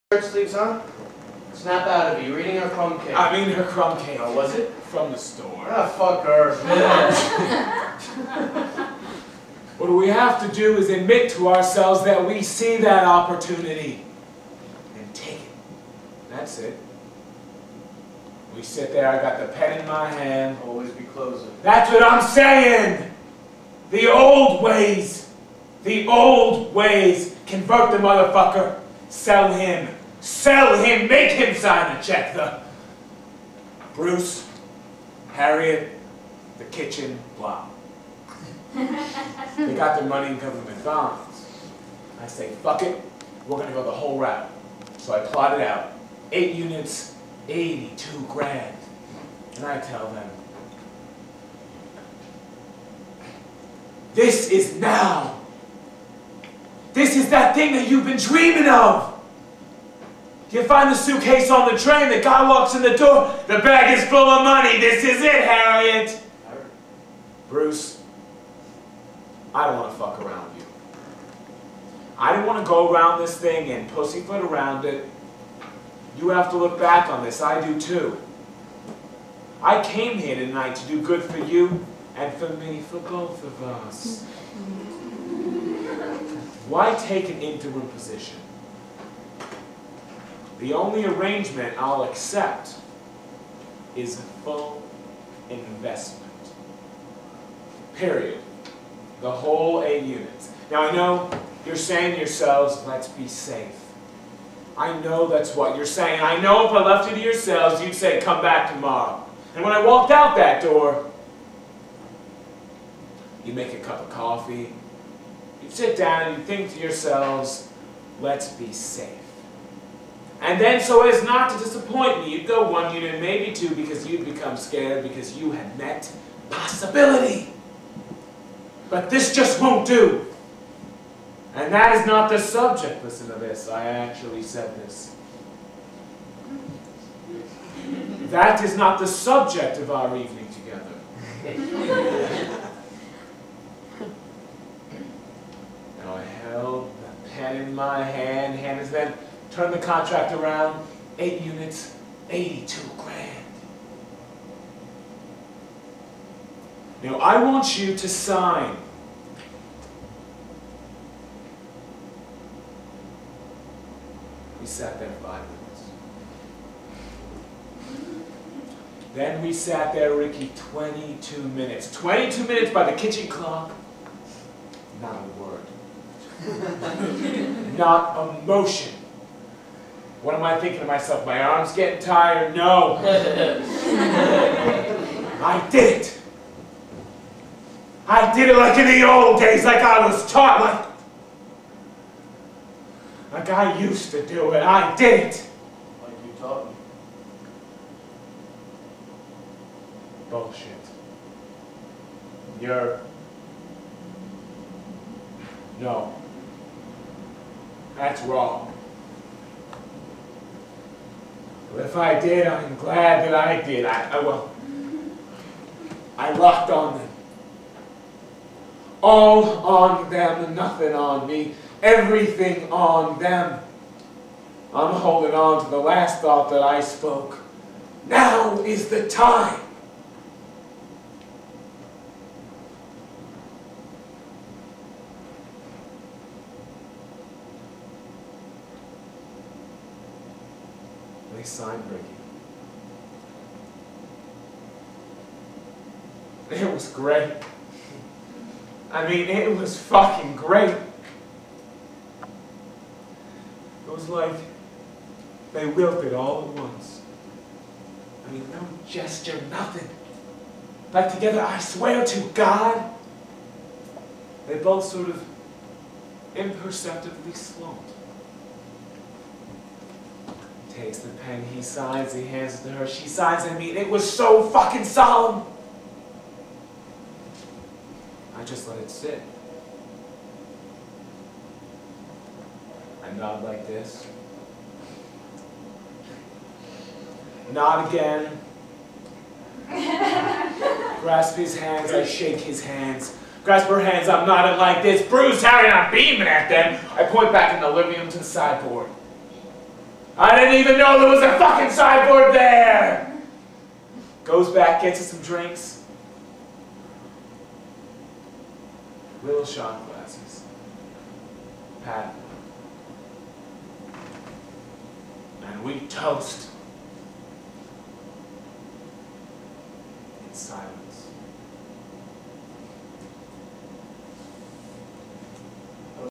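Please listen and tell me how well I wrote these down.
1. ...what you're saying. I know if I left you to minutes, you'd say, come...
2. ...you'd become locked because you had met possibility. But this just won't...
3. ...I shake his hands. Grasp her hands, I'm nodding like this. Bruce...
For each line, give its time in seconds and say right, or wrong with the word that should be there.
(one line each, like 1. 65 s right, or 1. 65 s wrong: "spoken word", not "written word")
1. 105 s wrong: "yourselves", not "minutes"
2. 124 s wrong: "scared", not "locked"
3. 291 s right.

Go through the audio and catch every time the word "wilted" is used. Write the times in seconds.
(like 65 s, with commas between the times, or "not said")
255 s.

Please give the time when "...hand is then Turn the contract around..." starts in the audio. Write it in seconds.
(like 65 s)
148 s.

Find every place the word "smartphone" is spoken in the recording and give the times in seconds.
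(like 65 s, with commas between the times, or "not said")
not said.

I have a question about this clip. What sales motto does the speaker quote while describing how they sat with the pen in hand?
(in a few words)
Always be closing.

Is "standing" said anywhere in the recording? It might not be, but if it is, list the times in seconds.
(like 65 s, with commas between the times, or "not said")
not said.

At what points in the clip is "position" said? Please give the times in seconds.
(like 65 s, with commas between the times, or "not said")
87 s.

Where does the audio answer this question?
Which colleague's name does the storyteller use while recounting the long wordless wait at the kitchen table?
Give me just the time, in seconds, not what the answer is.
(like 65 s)
170 s.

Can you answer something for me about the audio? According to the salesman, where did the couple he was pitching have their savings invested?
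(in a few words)
Government bonds.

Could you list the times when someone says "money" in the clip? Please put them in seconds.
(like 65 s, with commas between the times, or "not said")
40 s, 64 s.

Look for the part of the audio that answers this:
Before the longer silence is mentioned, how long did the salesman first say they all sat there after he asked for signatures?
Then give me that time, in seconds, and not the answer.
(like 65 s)
165 s.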